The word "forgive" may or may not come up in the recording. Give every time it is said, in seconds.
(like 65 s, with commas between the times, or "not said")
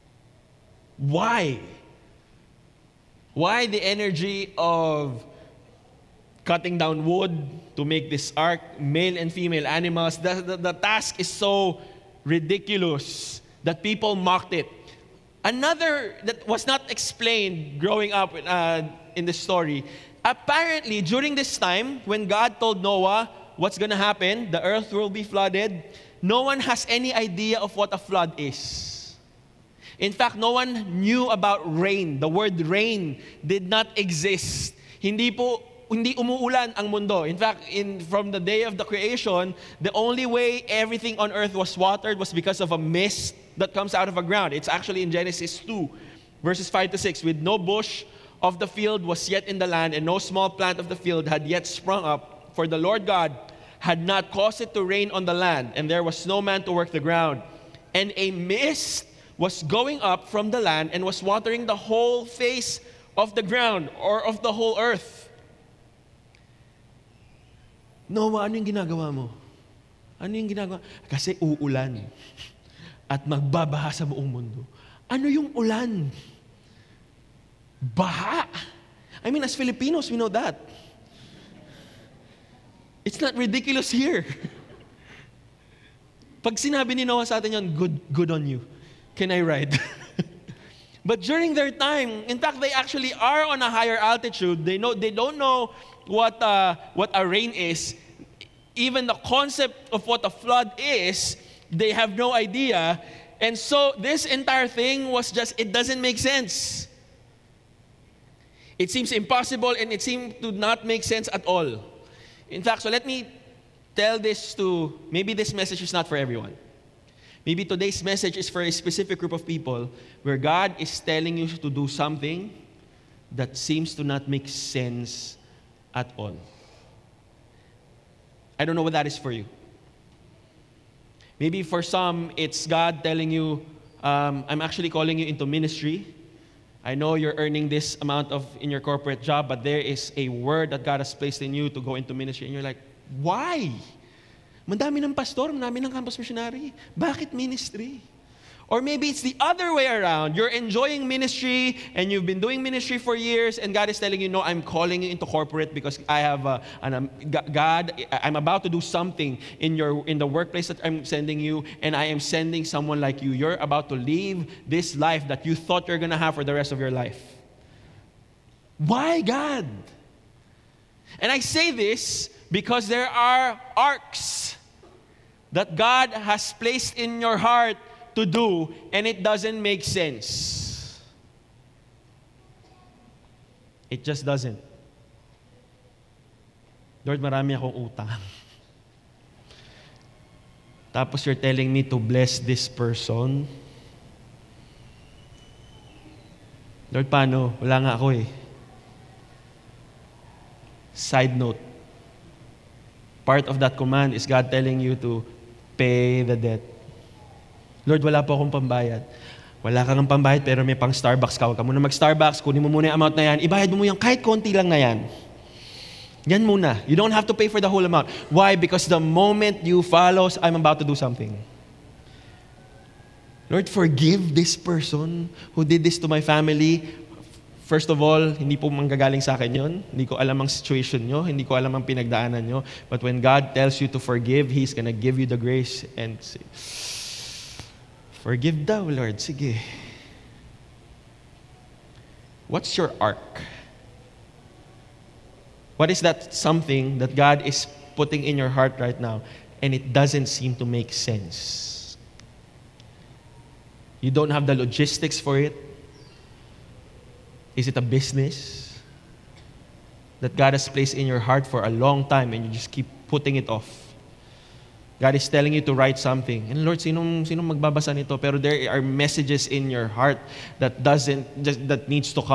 223 s, 233 s, 238 s.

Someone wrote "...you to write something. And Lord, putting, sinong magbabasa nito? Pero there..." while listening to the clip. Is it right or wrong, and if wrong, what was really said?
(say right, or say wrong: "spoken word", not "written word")
wrong: "sinong", not "putting".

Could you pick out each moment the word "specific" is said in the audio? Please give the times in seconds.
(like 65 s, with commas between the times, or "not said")
118 s.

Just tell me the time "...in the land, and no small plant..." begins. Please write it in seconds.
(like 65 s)
49 s.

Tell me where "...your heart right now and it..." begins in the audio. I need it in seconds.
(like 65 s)
248 s.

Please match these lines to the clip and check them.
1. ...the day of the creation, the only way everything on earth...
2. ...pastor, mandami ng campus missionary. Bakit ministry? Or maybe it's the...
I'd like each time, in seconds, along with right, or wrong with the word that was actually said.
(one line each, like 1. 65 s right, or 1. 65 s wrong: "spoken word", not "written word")
1. 38 s right
2. 145 s right.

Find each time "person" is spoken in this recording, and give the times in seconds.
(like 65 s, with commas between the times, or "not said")
192 s, 224 s.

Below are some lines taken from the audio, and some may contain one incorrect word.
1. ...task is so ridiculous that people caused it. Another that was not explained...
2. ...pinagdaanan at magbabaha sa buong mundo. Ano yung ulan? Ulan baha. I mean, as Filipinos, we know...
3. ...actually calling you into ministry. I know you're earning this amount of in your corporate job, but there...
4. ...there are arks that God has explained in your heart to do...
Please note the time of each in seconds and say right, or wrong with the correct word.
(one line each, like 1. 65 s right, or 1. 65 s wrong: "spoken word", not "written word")
1. 10 s wrong: "mocked", not "caused"
2. 71 s wrong: "uulan", not "pinagdaanan"
3. 134 s right
4. 172 s wrong: "placed", not "explained".